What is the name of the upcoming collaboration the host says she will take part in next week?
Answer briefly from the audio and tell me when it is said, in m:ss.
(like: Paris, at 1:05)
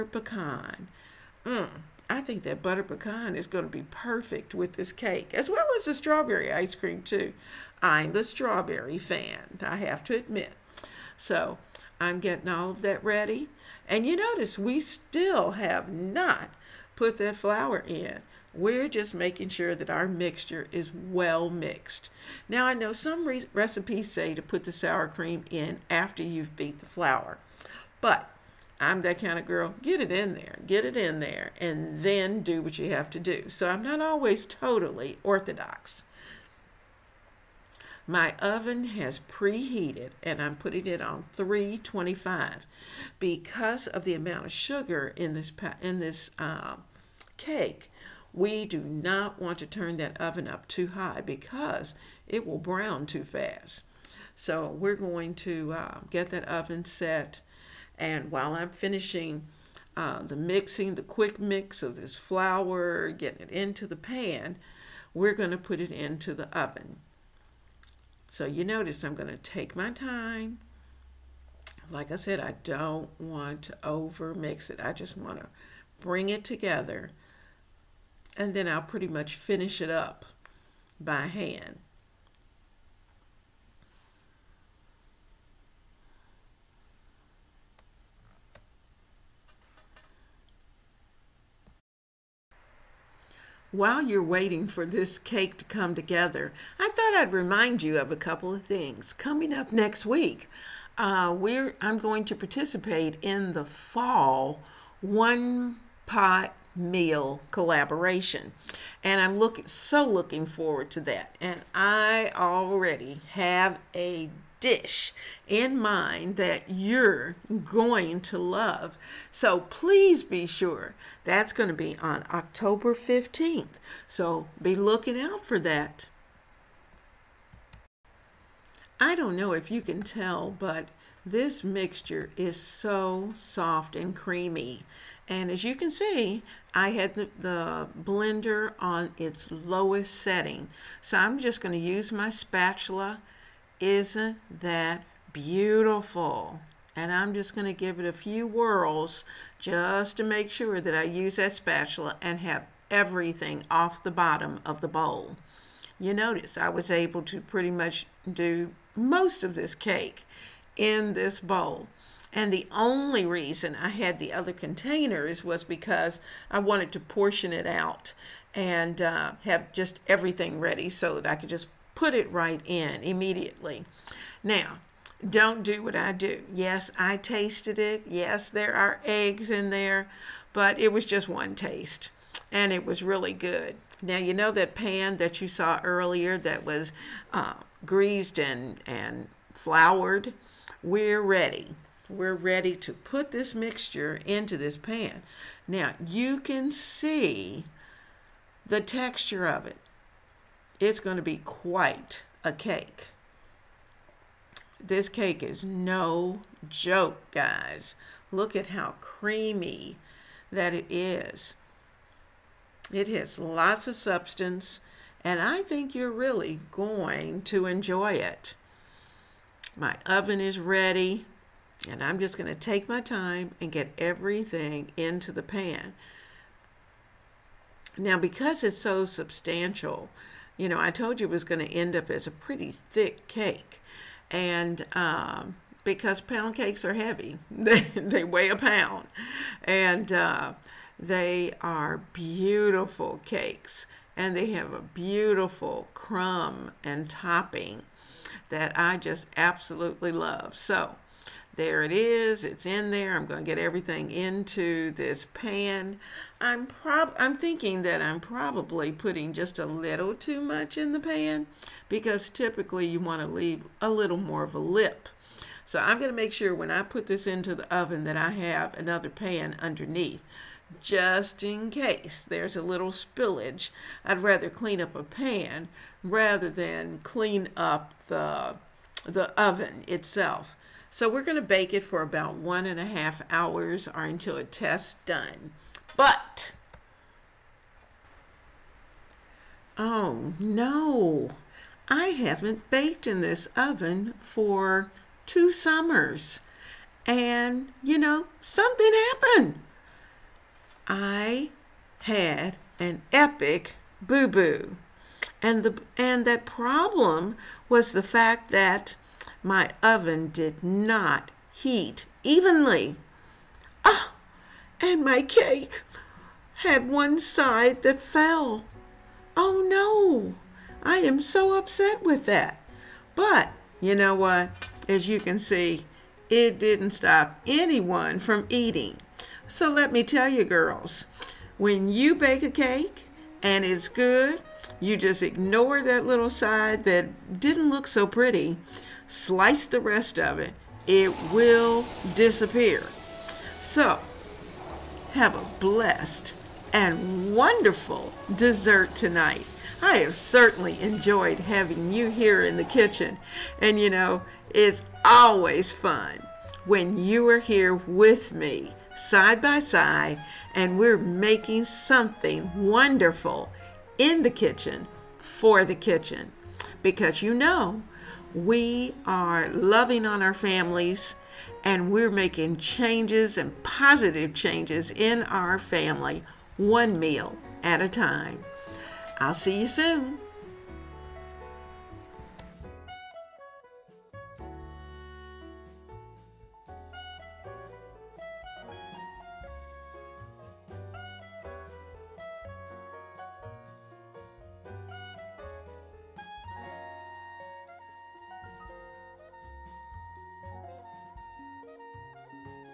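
fall one pot meal collaboration, at 1:43.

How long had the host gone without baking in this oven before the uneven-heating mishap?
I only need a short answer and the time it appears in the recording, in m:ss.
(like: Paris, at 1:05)
2 summers, at 4:55.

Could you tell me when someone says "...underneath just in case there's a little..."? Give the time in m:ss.
4:29.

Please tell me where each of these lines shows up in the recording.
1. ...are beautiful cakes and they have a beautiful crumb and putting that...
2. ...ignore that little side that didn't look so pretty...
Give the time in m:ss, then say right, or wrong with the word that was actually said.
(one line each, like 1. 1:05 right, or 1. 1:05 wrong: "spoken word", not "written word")
1. 4:01 wrong: "topping", not "putting"
2. 5:35 right.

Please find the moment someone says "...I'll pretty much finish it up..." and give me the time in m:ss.
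1:18.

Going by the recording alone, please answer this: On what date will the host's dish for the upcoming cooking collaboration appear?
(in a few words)
October 15th.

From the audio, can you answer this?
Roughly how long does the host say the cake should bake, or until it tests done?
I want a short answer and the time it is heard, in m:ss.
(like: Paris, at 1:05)
1.5 hours, at 4:42.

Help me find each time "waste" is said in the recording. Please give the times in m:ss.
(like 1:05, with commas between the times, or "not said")
not said.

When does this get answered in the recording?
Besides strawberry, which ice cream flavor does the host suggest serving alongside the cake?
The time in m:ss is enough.
0:02.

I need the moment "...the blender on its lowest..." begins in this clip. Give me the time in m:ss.
2:17.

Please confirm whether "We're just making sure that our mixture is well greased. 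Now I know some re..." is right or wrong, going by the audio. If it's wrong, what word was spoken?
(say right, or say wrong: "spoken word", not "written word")
wrong: "mixed", not "greased".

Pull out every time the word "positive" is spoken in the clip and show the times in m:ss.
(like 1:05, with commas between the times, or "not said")
6:13.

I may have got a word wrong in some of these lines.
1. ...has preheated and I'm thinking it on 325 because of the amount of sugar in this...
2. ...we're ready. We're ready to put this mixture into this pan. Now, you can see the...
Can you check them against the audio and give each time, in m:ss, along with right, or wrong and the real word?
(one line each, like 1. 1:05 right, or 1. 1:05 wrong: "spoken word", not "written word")
1. 0:38 wrong: "putting", not "thinking"
2. 3:10 right.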